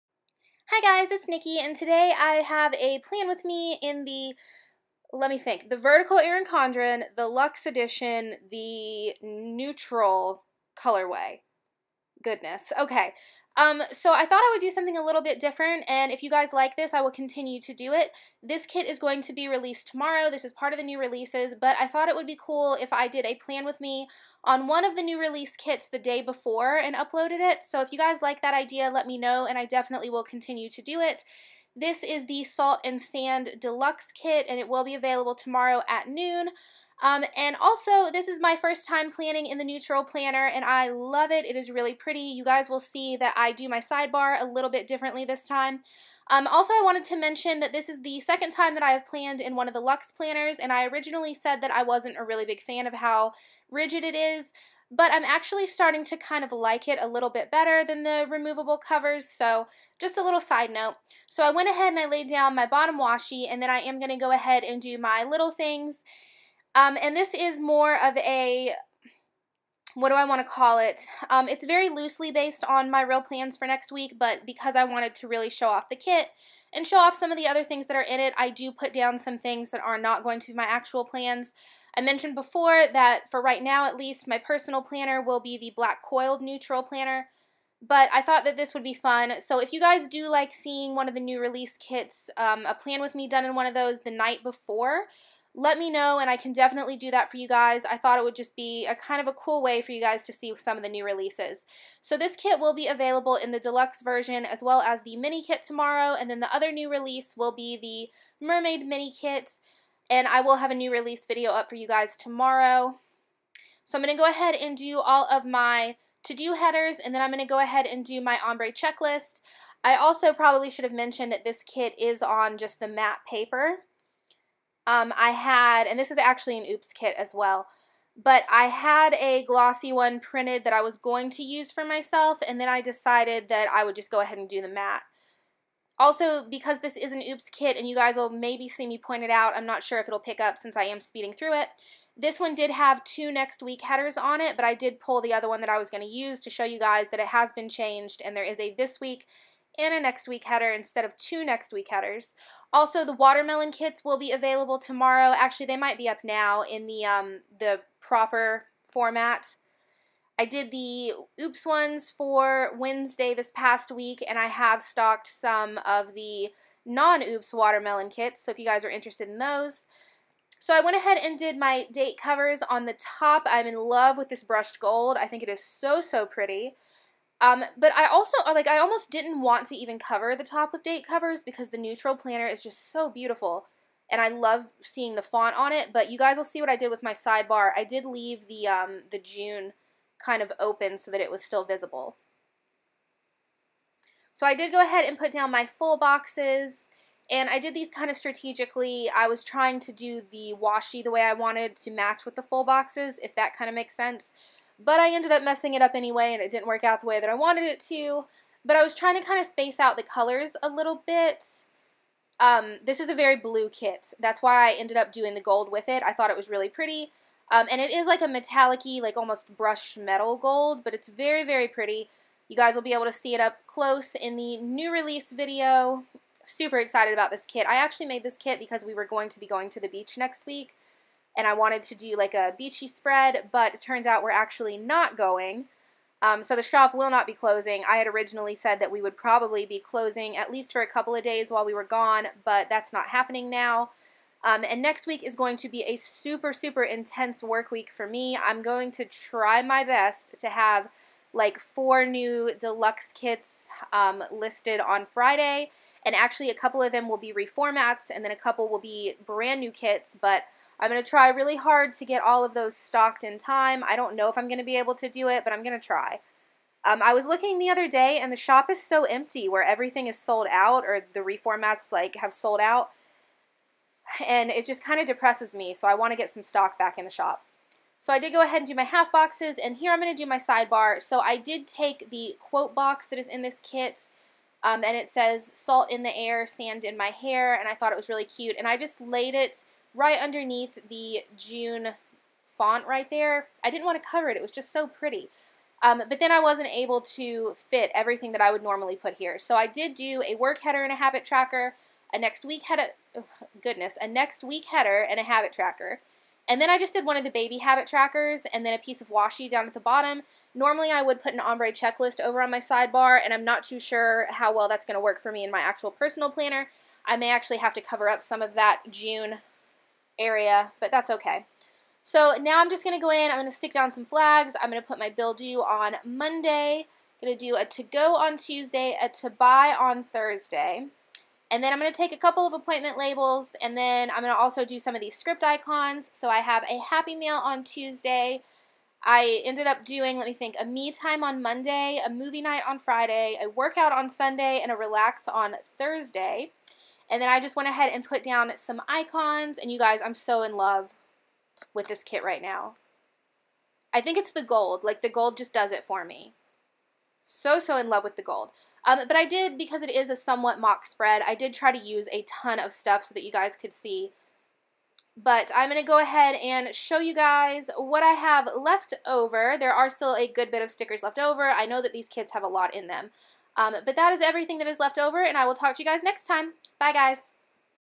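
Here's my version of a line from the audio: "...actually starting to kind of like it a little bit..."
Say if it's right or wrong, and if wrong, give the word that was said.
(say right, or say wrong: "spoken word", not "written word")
right.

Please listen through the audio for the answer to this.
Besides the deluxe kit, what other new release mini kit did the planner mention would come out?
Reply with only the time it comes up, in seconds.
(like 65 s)
108 s.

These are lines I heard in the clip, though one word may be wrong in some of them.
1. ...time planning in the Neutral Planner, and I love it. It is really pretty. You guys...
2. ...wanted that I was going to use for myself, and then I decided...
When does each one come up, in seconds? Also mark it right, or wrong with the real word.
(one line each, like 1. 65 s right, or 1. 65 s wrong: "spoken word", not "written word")
1. 38 s right
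2. 130 s wrong: "printed", not "wanted".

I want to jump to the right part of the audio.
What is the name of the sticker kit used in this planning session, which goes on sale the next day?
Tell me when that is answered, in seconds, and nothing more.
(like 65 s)
32 s.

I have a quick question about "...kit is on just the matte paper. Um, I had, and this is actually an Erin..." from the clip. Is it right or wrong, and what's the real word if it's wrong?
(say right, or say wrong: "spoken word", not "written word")
wrong: "Oops", not "Erin".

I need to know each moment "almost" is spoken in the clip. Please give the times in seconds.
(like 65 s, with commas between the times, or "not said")
178 s, 219 s.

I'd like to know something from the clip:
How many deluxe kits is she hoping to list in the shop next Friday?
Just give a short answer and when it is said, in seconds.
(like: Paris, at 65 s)
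4, at 251 s.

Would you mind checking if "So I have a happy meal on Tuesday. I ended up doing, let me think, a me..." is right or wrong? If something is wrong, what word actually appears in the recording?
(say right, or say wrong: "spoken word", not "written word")
right.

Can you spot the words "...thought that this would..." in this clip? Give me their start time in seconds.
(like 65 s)
88 s.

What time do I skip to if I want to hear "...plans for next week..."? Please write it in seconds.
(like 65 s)
73 s.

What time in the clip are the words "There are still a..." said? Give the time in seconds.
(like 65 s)
369 s.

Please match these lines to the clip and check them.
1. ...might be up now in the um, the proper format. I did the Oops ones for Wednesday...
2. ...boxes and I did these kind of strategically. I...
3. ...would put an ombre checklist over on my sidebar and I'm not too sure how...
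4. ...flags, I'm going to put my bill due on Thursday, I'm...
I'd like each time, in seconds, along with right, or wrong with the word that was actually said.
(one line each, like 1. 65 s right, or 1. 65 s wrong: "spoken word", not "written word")
1. 155 s right
2. 195 s right
3. 311 s right
4. 324 s wrong: "Monday", not "Thursday".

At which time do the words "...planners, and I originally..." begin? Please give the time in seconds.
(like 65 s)
50 s.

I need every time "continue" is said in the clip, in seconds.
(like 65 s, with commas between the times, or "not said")
17 s, 30 s.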